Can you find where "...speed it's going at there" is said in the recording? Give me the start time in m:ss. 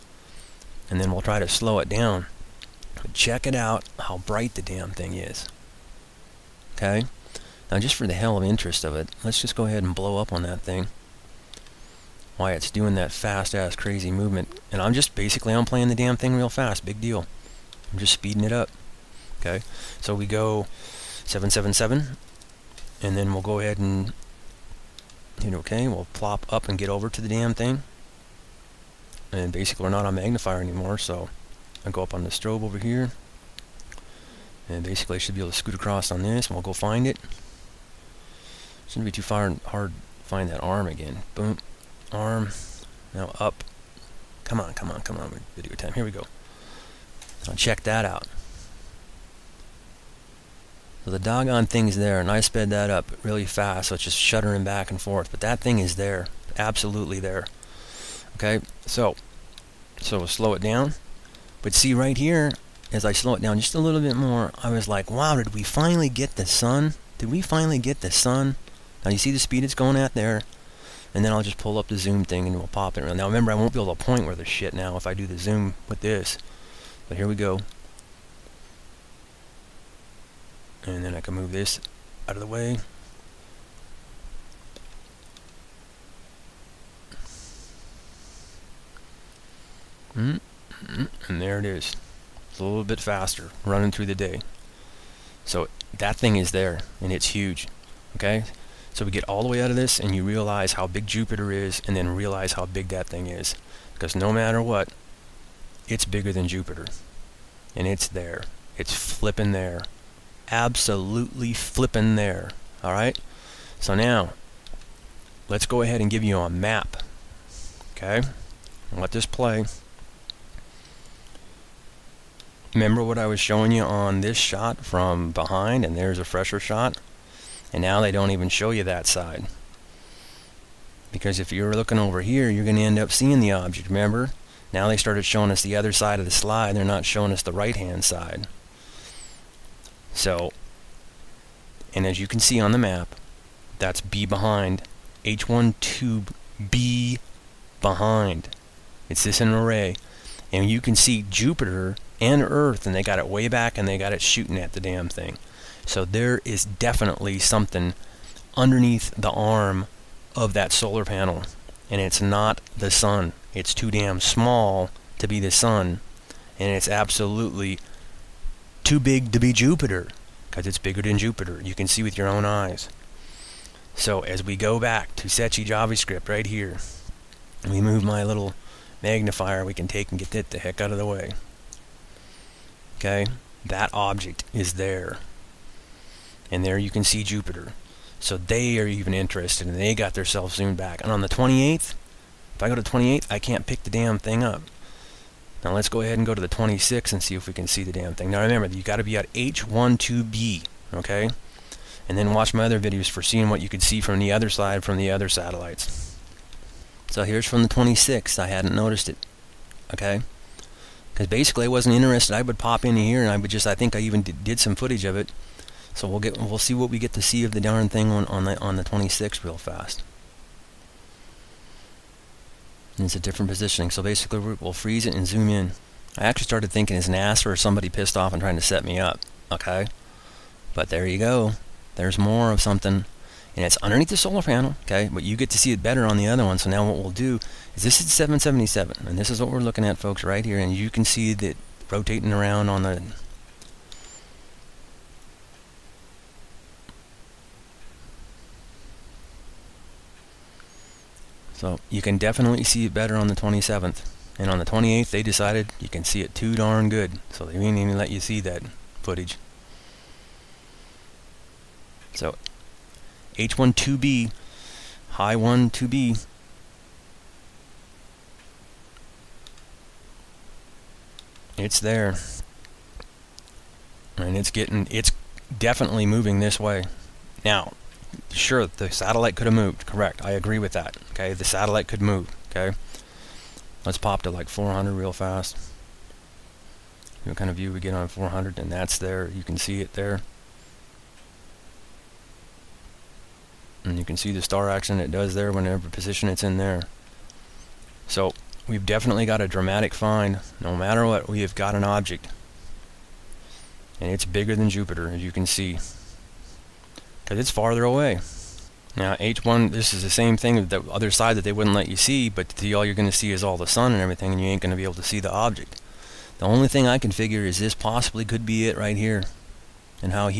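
1:09.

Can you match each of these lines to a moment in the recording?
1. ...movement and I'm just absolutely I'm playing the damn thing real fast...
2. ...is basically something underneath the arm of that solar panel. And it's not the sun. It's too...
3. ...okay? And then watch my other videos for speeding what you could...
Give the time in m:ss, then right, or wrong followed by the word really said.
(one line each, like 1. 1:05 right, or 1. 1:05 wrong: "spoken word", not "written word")
1. 0:14 wrong: "basically", not "absolutely"
2. 2:36 wrong: "definitely", not "basically"
3. 3:20 wrong: "seeing", not "speeding".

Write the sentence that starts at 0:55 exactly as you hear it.
But that thing is there, absolutely there.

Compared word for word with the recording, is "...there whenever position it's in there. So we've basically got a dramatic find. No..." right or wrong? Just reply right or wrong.
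wrong.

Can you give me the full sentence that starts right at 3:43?
So basically we'll freeze it and zoom in.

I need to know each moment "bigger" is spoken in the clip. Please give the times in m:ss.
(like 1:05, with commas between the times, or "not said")
1:46, 2:50, 5:04.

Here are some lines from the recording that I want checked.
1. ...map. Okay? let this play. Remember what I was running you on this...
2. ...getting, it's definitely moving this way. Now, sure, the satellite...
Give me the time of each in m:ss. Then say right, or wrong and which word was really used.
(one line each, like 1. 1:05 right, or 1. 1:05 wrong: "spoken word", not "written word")
1. 1:56 wrong: "showing", not "running"
2. 4:34 right.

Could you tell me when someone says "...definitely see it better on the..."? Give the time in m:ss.
4:12.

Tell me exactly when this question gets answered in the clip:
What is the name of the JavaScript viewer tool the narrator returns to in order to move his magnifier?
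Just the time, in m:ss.
2:55.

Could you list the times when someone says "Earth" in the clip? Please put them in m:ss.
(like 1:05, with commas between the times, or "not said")
2:32.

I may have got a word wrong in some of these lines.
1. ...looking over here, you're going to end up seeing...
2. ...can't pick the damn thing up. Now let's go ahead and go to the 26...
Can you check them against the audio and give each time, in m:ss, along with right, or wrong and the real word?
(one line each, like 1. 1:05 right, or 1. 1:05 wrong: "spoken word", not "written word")
1. 2:11 right
2. 3:13 right.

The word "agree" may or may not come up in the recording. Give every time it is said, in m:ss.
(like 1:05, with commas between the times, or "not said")
4:40.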